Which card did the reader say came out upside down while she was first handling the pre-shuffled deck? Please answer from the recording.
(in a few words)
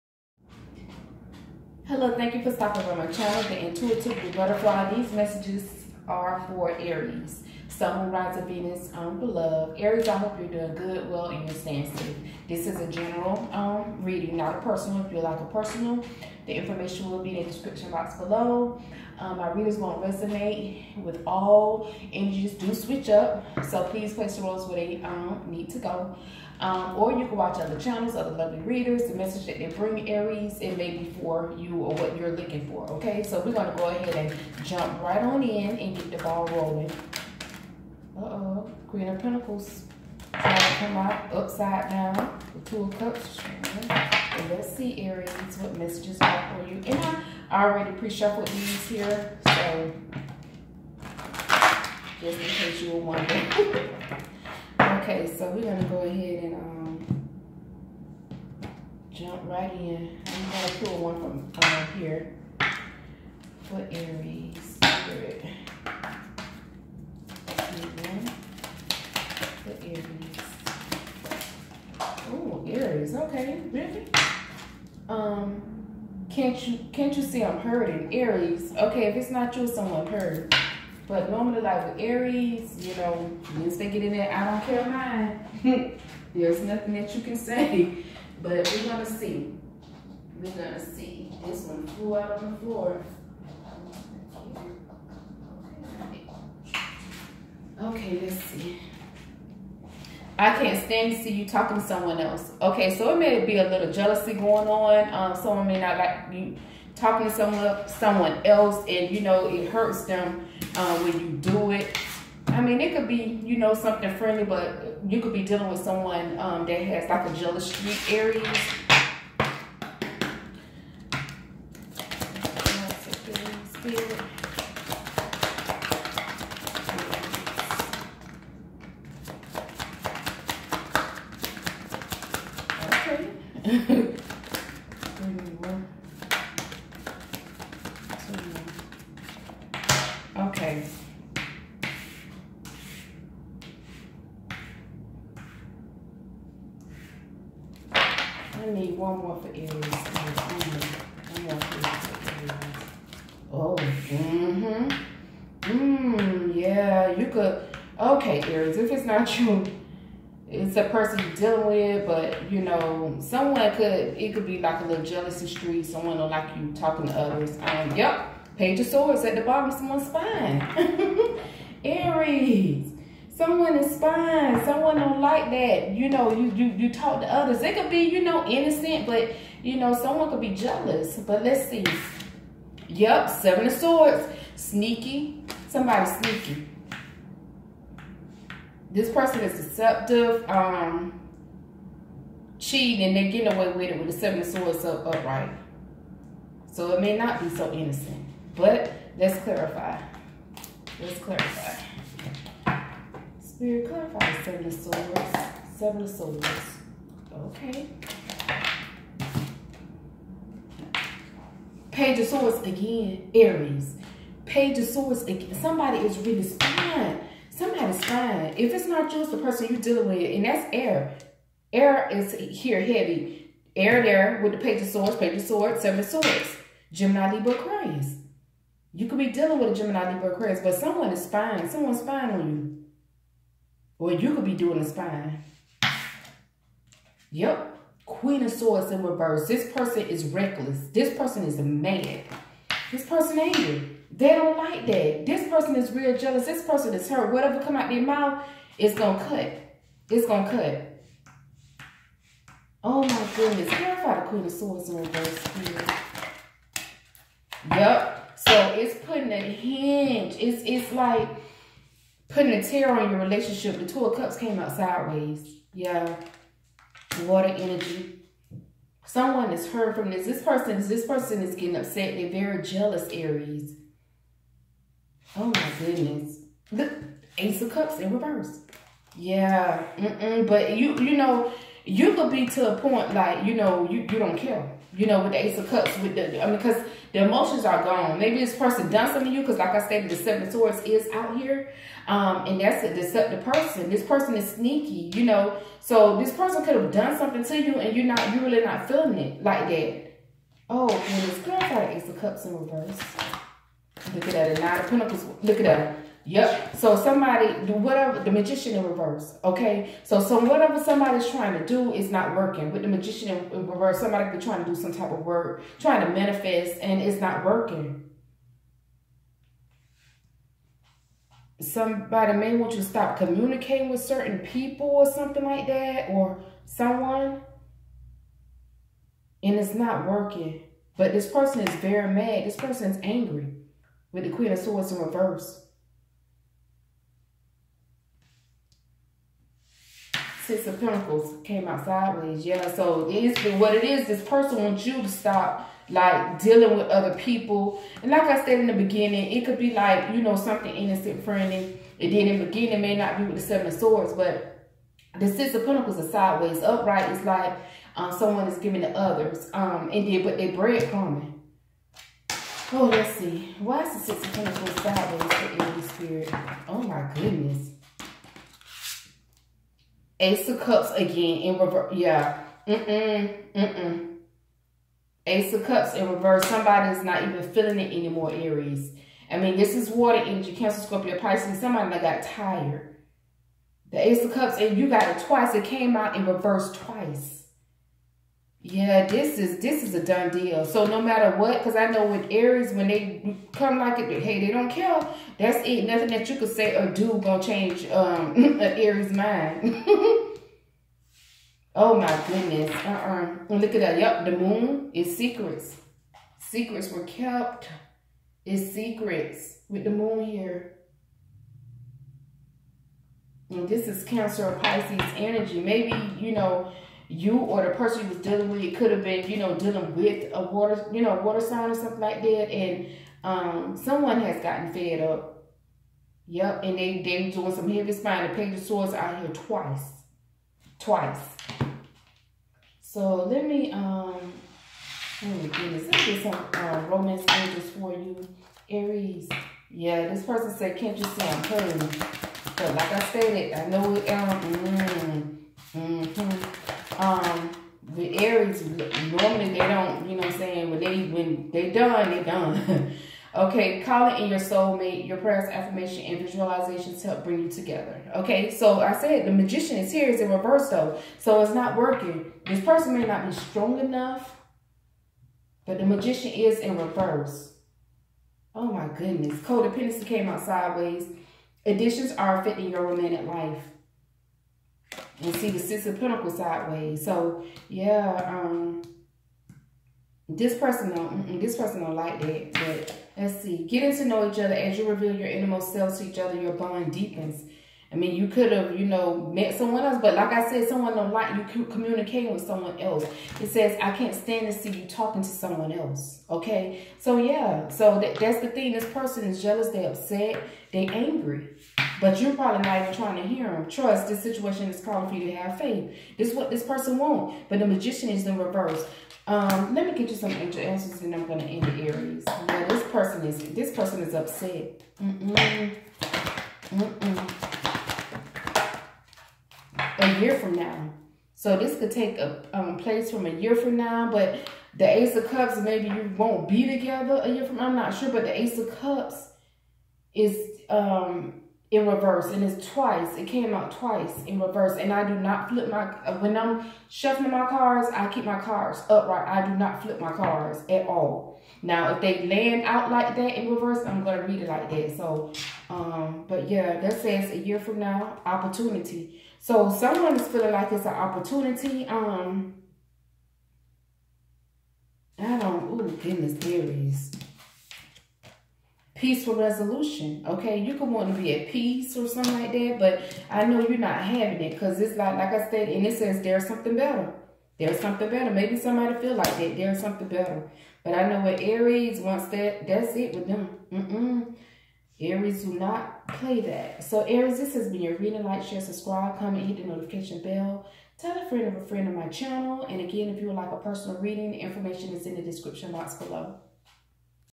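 Queen of Pentacles.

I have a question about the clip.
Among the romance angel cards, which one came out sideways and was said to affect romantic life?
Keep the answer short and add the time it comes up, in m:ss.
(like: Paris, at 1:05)
Codependency, at 7:49.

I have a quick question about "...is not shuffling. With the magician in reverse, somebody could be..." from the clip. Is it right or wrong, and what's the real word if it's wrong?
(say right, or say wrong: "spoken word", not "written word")
wrong: "working", not "shuffling".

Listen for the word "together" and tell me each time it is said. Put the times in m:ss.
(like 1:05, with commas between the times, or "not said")
7:37, 8:46.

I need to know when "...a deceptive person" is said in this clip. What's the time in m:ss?
4:52.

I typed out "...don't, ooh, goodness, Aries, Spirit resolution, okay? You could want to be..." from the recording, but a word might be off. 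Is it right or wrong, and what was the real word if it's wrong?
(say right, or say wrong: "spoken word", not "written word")
wrong: "Peaceful", not "Spirit".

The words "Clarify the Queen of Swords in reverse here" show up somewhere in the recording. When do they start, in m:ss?
4:13.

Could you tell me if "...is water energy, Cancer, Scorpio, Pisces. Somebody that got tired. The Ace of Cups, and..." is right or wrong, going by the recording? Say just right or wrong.
right.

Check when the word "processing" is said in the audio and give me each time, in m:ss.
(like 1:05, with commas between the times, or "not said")
not said.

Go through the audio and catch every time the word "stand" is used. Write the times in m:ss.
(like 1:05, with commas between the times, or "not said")
1:40, 8:14.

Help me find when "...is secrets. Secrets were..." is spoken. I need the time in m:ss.
6:44.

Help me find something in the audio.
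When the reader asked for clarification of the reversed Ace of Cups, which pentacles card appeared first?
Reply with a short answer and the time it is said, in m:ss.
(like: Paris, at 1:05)
Nine of Pentacles, at 5:04.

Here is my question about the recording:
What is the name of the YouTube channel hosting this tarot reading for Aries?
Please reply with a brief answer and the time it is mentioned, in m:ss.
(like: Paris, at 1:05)
The Intuitive Butterfly, at 0:03.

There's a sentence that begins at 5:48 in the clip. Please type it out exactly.
And like I said in the beginning, it could be like, you know, something innocent friendly.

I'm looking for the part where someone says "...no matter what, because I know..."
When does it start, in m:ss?
6:30.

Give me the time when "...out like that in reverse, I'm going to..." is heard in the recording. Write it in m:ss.
9:02.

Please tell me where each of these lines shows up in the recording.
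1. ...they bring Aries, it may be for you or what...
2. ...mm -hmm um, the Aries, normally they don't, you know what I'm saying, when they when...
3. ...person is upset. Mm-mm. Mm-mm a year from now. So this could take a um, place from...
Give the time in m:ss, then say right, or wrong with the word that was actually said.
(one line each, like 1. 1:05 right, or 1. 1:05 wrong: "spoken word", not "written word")
1. 0:29 right
2. 7:25 right
3. 8:33 right.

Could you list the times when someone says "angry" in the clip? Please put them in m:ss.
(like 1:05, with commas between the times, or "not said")
4:03, 5:33, 8:20.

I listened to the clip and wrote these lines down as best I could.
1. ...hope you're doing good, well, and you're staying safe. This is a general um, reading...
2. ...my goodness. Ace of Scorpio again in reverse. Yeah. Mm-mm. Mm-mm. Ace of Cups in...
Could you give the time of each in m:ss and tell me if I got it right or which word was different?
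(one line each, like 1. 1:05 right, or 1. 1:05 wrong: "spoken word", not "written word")
1. 0:10 right
2. 6:06 wrong: "Cups", not "Scorpio".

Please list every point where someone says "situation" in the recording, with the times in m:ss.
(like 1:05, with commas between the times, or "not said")
8:24.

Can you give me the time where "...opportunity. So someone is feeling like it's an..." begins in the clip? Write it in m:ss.
9:08.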